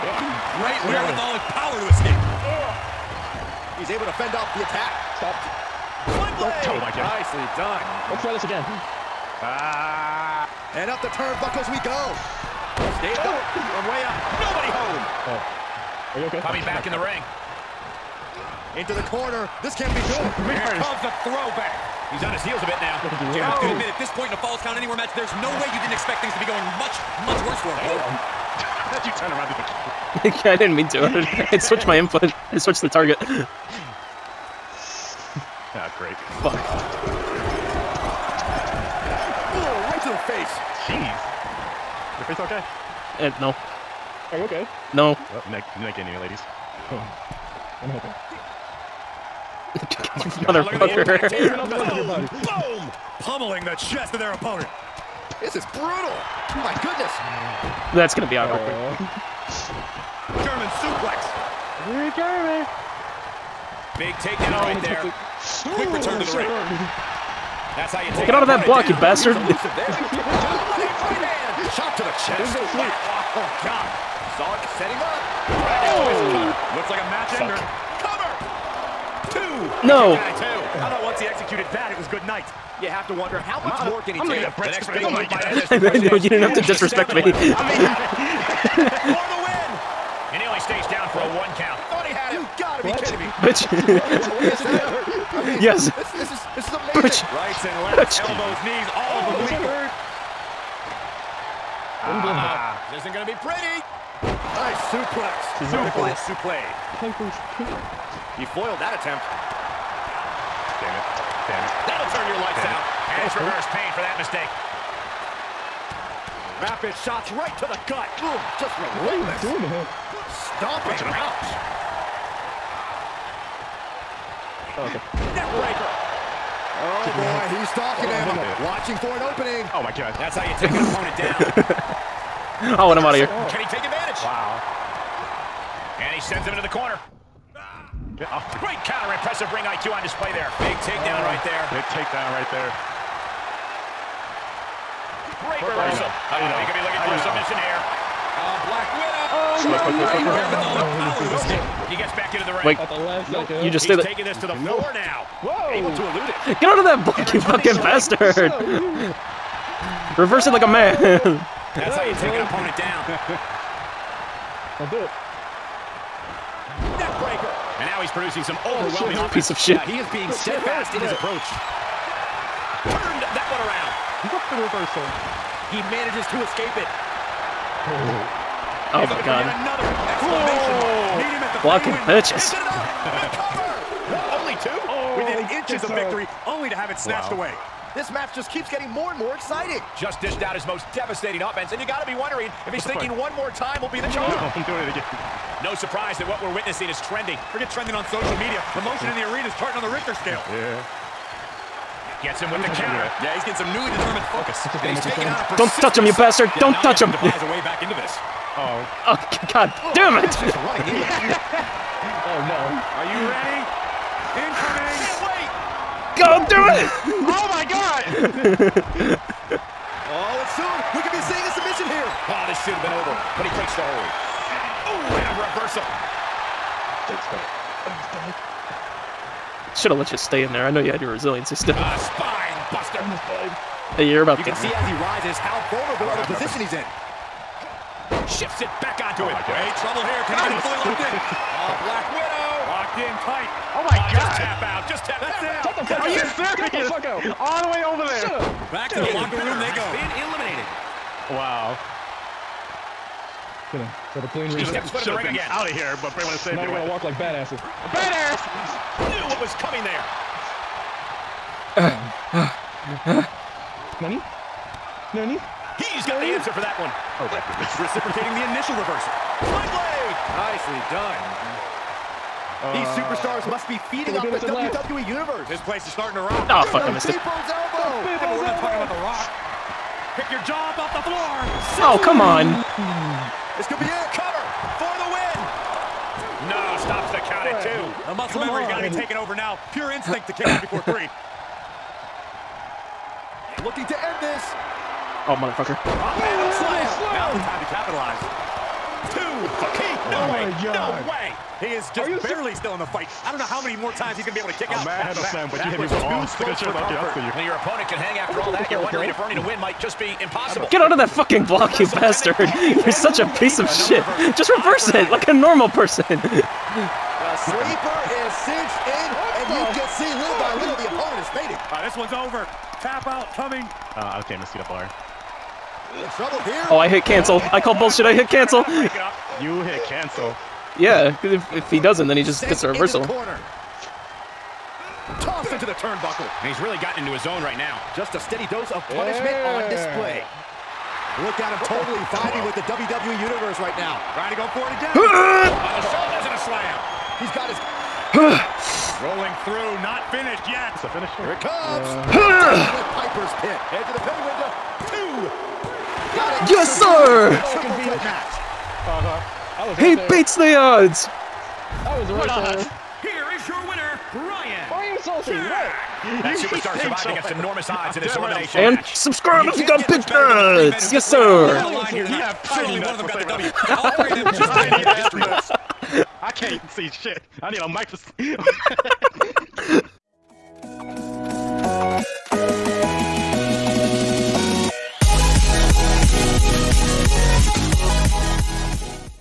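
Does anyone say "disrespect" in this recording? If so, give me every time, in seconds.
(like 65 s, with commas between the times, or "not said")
86 s.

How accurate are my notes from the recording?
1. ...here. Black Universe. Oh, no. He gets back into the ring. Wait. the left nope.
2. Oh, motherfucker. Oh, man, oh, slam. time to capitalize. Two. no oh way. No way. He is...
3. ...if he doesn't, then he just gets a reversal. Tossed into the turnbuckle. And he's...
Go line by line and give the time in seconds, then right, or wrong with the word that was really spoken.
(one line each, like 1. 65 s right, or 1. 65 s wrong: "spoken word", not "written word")
1. 147 s wrong: "Widow", not "Universe"
2. 295 s right
3. 331 s right.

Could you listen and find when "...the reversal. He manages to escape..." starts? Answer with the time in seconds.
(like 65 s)
174 s.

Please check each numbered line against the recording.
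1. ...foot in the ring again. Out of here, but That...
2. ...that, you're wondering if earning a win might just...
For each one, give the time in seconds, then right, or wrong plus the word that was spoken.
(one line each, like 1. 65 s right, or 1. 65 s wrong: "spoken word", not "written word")
1. 254 s wrong: "Bray", not "That"
2. 308 s right.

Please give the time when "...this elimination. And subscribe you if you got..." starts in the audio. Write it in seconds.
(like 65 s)
368 s.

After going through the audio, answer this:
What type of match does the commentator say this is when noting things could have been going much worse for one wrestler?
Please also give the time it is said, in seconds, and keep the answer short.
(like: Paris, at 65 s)
Falls Count Anywhere, at 24 s.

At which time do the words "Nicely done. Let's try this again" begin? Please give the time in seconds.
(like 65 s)
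7 s.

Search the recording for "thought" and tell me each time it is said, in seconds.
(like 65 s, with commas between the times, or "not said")
80 s, 91 s.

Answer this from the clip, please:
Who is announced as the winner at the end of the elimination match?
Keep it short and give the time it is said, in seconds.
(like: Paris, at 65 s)
Brian, at 364 s.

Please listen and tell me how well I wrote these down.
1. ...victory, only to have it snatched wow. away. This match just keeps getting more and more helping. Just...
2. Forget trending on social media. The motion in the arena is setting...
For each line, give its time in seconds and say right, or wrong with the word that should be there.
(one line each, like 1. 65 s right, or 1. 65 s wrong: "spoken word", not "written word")
1. 185 s wrong: "exciting", not "helping"
2. 197 s wrong: "charting", not "setting".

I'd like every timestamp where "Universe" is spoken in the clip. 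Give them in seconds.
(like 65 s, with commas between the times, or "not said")
275 s, 343 s.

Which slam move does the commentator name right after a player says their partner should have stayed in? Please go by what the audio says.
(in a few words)
Spine buster.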